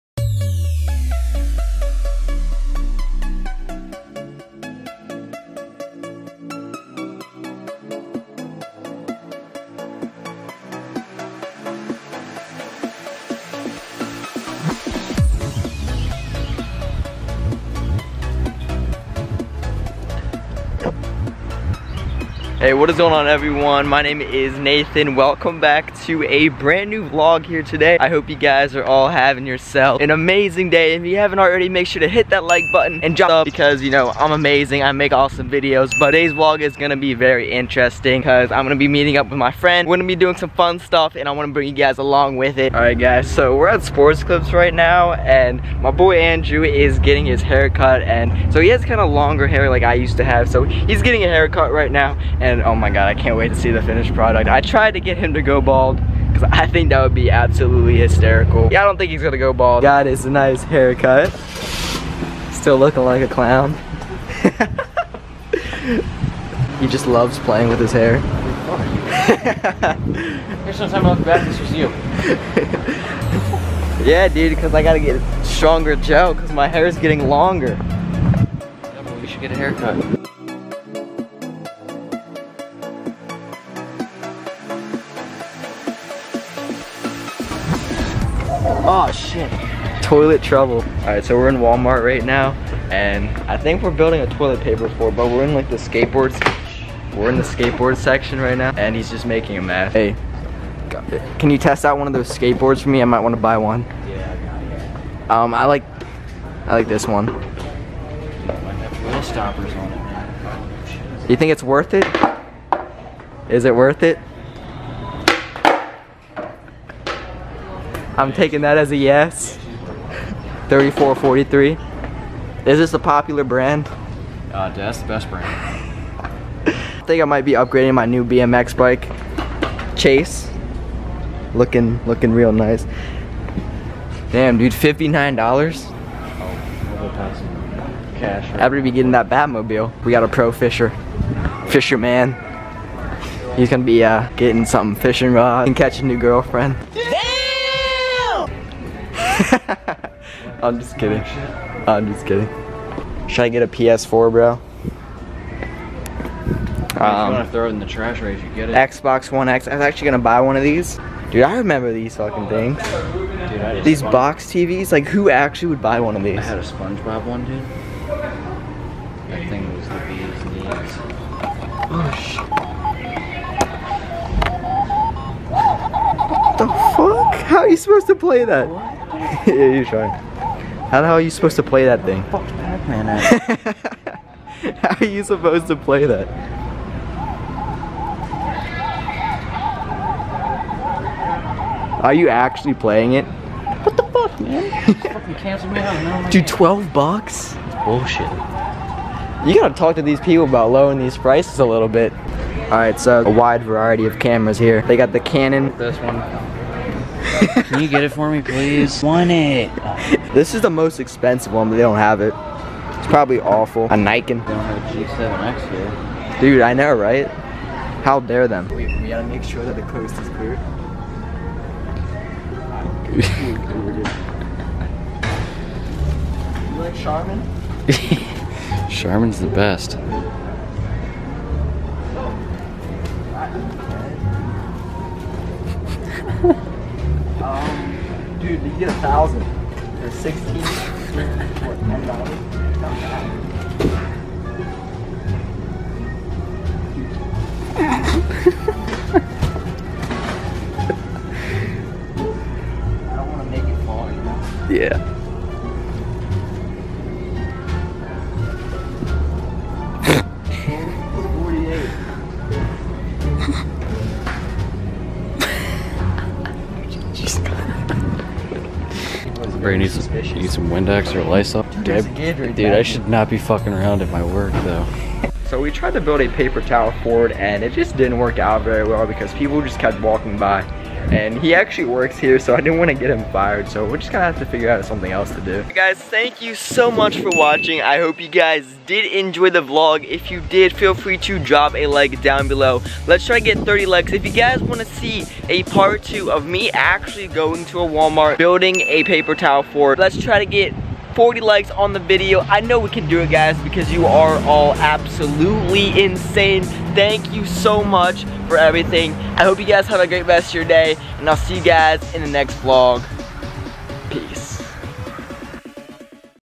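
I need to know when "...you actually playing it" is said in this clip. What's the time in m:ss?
3:12.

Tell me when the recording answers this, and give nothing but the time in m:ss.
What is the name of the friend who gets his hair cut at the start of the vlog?
0:46.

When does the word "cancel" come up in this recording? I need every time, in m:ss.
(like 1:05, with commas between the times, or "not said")
3:15.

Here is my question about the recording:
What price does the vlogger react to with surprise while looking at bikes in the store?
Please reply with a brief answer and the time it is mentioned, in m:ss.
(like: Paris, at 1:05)
$59, at 2:14.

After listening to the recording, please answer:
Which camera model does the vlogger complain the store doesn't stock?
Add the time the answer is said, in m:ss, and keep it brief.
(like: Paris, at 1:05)
G7X, at 3:35.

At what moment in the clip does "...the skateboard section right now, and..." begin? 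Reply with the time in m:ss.
1:37.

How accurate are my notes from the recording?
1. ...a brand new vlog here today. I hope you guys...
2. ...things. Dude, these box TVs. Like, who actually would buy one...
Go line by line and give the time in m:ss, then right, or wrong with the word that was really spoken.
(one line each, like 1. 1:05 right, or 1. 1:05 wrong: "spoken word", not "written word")
1. 0:26 right
2. 2:42 right.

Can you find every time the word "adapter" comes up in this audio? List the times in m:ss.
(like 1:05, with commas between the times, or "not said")
not said.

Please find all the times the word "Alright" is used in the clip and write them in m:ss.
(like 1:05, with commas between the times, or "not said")
0:42, 3:22.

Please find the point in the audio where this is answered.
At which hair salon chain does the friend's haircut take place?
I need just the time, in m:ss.
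0:43.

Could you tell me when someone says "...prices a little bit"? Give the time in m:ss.
3:21.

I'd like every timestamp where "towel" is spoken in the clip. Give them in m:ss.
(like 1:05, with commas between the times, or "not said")
4:36, 4:59.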